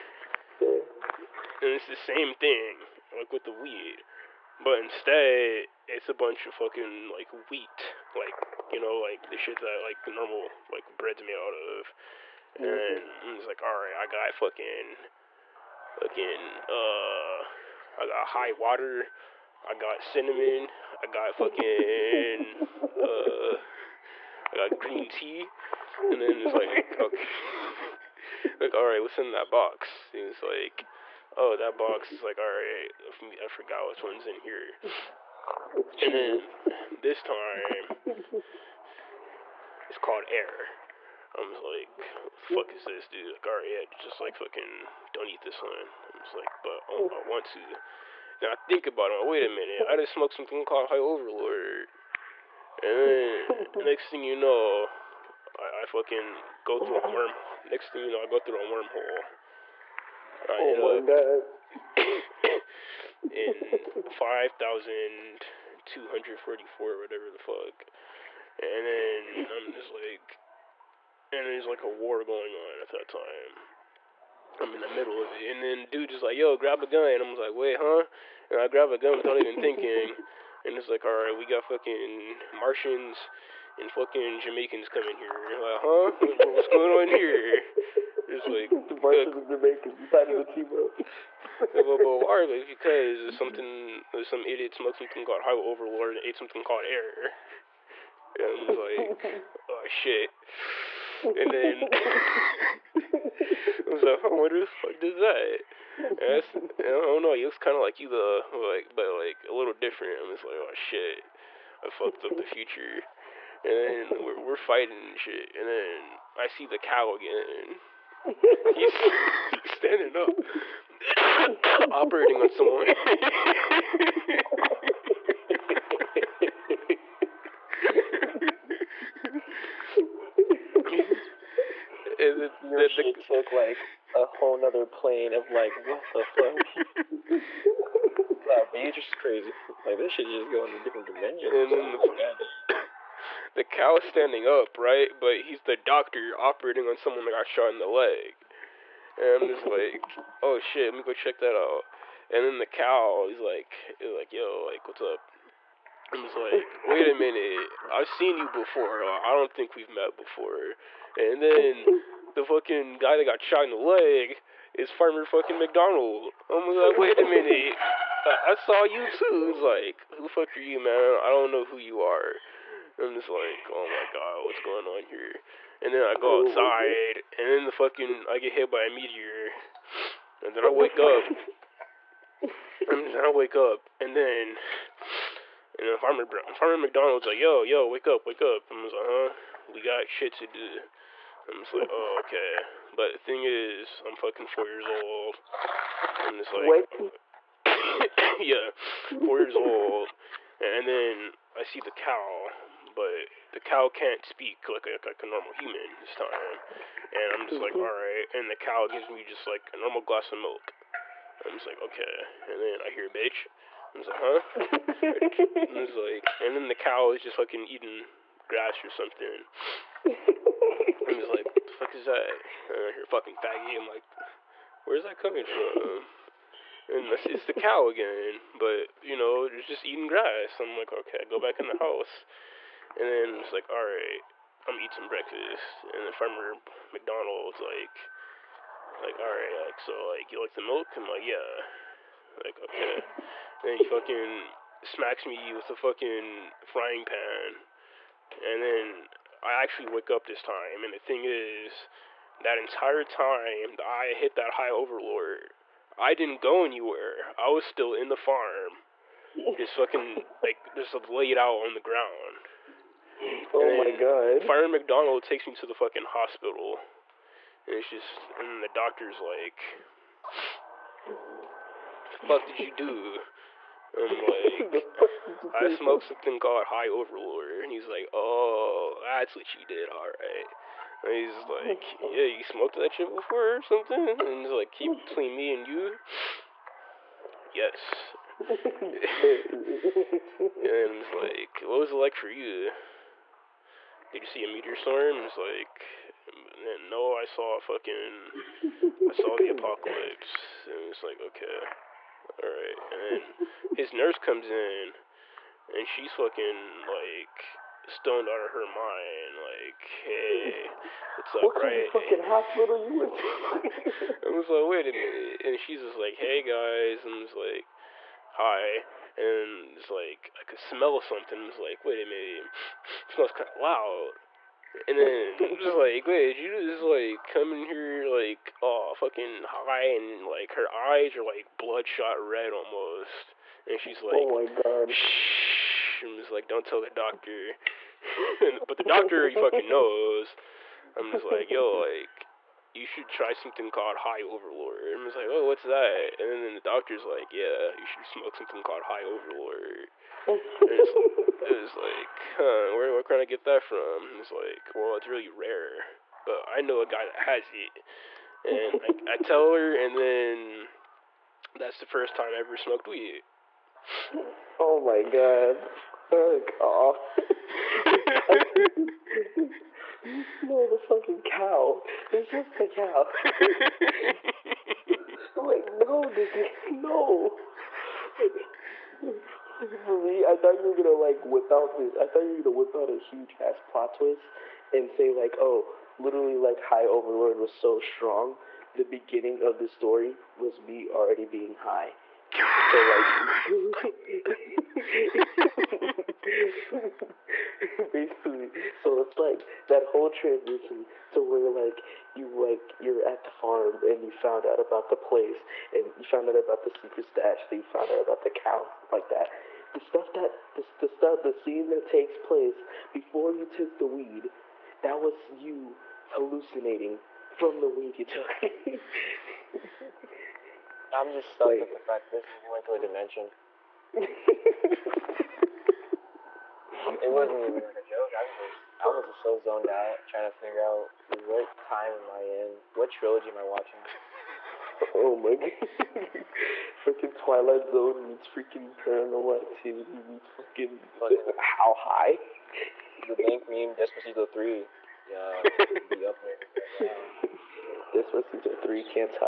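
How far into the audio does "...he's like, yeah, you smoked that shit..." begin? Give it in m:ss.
4:41.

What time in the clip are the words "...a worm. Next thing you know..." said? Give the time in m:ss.
0:57.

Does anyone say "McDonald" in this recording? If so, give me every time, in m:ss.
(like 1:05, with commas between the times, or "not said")
2:45, 3:06, 3:56, 4:24.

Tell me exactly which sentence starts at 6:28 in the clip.
The beginning of the story was me already being high.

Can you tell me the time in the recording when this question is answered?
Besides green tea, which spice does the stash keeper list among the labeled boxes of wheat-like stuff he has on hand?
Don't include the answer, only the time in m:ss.
0:20.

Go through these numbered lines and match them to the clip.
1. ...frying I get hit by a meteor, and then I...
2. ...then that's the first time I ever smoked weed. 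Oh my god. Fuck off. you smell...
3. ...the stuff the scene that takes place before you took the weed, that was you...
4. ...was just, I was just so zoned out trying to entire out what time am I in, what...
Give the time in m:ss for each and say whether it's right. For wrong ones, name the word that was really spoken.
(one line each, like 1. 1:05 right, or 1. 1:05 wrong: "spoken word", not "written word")
1. 2:57 wrong: "fucking", not "frying"
2. 5:59 right
3. 6:50 right
4. 7:08 wrong: "figure", not "entire".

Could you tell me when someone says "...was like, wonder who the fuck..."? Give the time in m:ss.
1:43.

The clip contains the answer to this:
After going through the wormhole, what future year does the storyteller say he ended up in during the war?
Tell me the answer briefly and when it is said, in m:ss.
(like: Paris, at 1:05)
5244, at 1:04.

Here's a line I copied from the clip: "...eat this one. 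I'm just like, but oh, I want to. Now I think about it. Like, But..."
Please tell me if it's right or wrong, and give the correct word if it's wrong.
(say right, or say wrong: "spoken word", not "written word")
wrong: "Wait", not "But".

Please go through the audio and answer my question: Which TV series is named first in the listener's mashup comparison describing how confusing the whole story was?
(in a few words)
Twilight Zone.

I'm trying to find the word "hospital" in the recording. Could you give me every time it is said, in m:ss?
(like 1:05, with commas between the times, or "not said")
4:26, 5:12.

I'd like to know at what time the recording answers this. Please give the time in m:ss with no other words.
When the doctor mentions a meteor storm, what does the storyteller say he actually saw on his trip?
4:59.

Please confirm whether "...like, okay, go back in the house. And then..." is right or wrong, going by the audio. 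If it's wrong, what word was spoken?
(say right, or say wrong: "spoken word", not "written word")
right.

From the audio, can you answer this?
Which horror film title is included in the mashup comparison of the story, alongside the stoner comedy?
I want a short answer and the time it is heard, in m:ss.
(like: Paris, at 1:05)
Paranormal Activity, at 7:18.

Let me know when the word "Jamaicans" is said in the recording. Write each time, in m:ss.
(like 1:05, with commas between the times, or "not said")
1:24, 1:29.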